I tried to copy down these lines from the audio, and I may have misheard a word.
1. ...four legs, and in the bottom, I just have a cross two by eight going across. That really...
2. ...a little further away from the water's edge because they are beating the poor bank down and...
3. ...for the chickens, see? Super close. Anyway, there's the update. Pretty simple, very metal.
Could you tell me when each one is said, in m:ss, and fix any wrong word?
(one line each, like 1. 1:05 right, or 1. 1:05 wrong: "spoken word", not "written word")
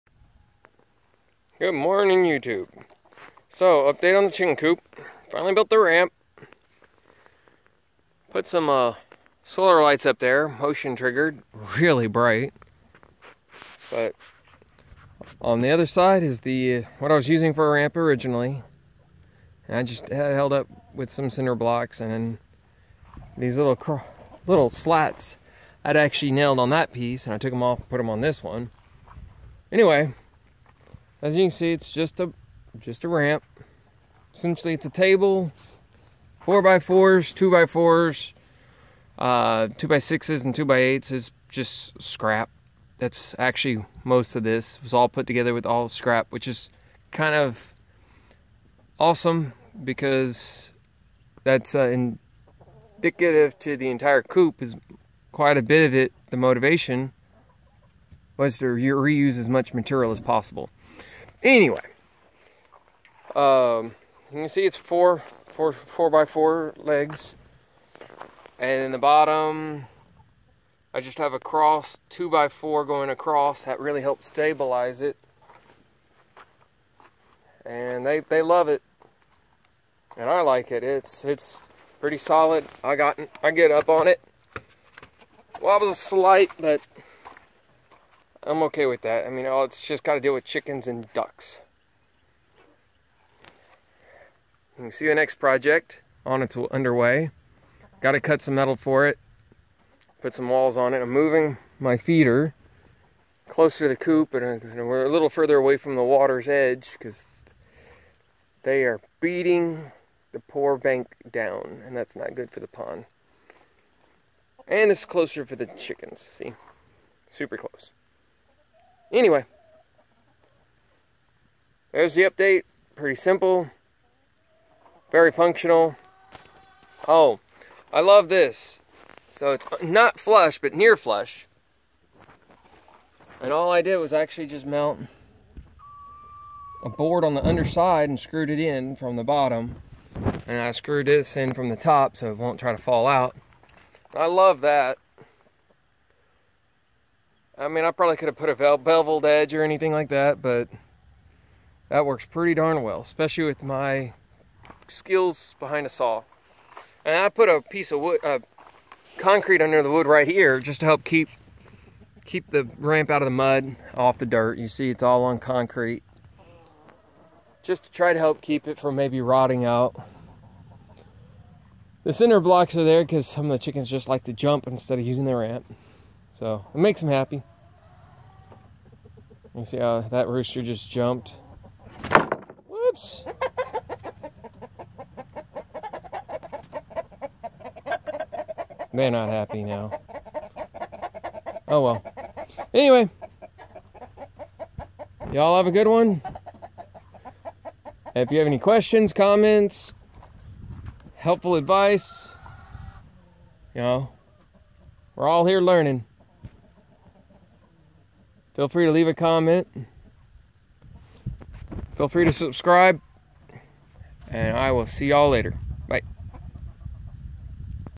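1. 1:06 wrong: "four", not "eight"
2. 1:45 right
3. 1:55 wrong: "functional", not "metal".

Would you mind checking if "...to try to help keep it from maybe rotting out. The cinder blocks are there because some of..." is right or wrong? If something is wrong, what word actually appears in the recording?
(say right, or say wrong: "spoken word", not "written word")
right.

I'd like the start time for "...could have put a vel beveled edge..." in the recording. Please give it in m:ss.
2:28.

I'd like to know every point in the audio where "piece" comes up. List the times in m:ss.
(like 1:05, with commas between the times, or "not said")
0:26, 2:37.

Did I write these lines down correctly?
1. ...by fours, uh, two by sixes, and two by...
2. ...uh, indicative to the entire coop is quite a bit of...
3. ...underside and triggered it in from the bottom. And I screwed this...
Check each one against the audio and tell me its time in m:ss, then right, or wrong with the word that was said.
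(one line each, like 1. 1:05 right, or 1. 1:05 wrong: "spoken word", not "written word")
1. 0:37 right
2. 0:51 right
3. 2:17 wrong: "screwed", not "triggered".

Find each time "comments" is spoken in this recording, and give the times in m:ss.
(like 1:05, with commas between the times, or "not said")
3:19, 3:29.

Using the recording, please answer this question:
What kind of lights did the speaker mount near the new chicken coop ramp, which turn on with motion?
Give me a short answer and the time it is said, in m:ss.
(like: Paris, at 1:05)
Solar lights, at 0:09.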